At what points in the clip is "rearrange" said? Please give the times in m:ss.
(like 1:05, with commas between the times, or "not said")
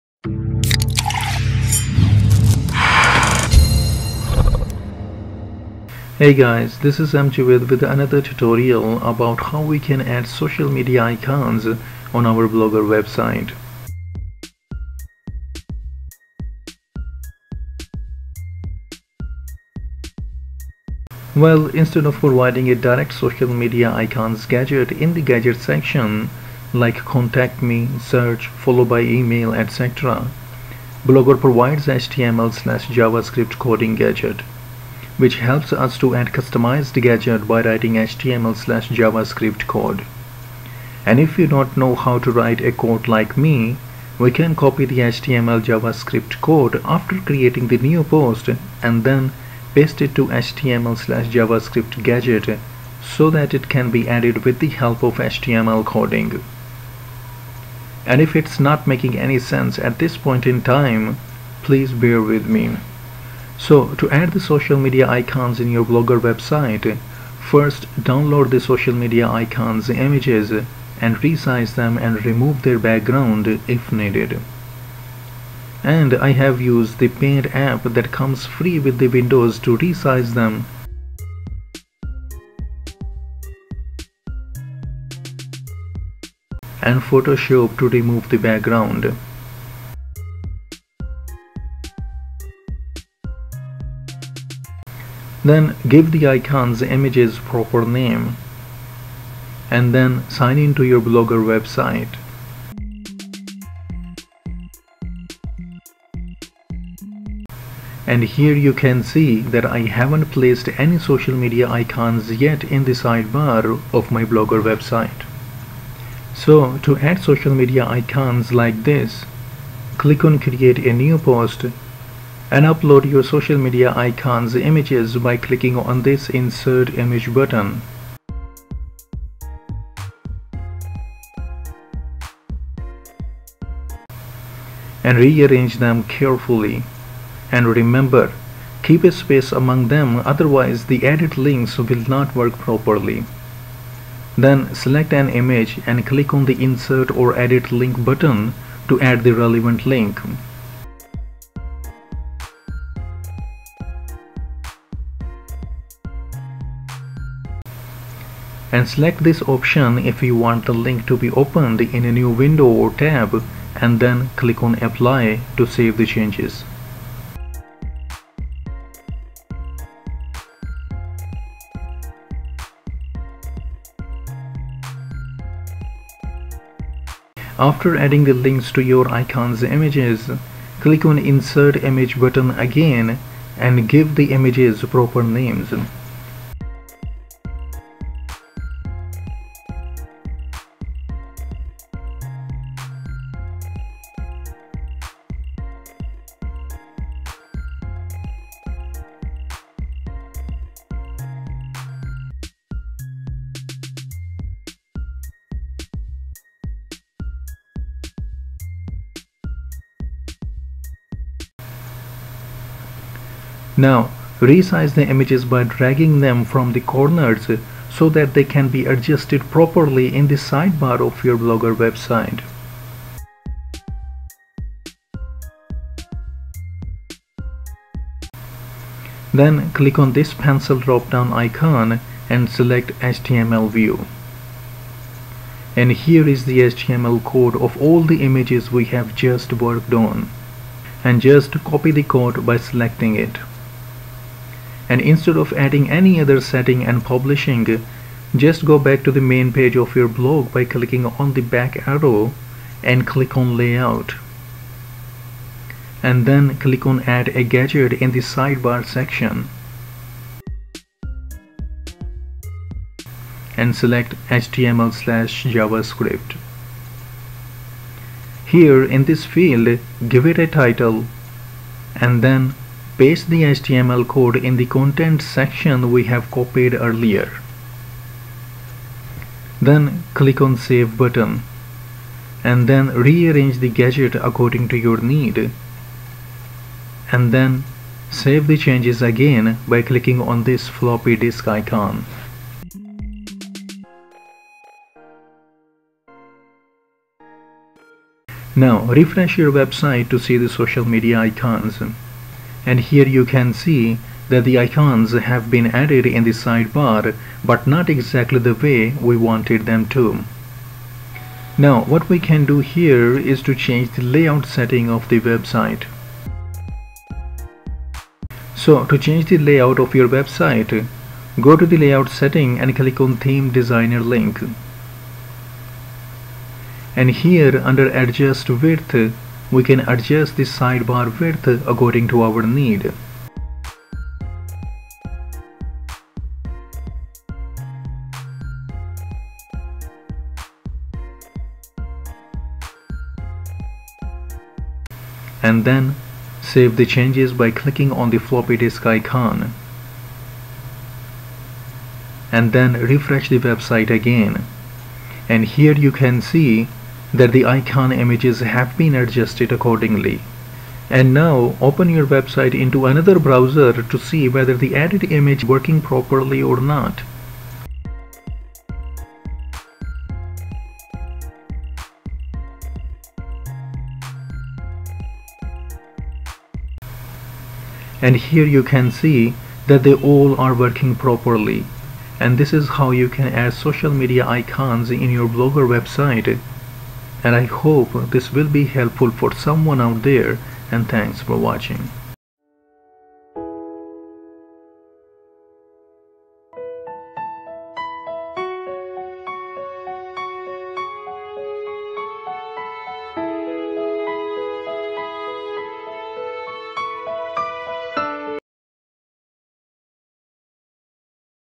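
2:15, 4:43.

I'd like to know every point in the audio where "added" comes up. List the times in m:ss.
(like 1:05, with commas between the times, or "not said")
0:54, 5:05, 6:04.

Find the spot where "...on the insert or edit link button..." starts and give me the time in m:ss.
2:26.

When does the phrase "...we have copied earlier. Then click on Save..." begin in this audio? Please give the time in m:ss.
4:35.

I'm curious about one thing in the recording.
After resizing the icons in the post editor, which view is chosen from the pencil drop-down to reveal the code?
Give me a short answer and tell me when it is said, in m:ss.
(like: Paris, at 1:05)
HTML view, at 3:52.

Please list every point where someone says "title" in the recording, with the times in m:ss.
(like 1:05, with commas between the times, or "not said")
4:30.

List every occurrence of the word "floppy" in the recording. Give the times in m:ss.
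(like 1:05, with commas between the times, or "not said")
4:50, 5:48.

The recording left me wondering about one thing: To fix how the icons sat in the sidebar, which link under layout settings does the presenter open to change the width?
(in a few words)
Theme designer.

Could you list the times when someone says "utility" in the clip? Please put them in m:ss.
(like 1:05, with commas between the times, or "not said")
not said.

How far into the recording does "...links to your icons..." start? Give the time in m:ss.
2:58.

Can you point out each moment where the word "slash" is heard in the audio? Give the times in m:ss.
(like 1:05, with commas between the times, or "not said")
0:32, 0:38, 0:50, 4:24.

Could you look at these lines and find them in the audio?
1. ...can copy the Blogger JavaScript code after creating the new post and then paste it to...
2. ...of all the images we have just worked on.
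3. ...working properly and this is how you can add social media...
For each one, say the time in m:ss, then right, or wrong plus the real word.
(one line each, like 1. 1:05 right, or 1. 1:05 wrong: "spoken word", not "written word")
1. 0:44 wrong: "HTML", not "Blogger"
2. 3:57 right
3. 6:20 right.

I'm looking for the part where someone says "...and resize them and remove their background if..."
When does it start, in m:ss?
1:10.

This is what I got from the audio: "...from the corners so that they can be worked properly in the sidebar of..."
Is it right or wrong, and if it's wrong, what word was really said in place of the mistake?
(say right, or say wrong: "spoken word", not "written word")
wrong: "adjusted", not "worked".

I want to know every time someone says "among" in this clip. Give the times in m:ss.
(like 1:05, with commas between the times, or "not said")
2:19.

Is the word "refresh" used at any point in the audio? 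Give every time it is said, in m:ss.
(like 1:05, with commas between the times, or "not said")
4:58, 5:52.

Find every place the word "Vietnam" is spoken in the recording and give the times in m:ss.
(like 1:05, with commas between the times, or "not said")
not said.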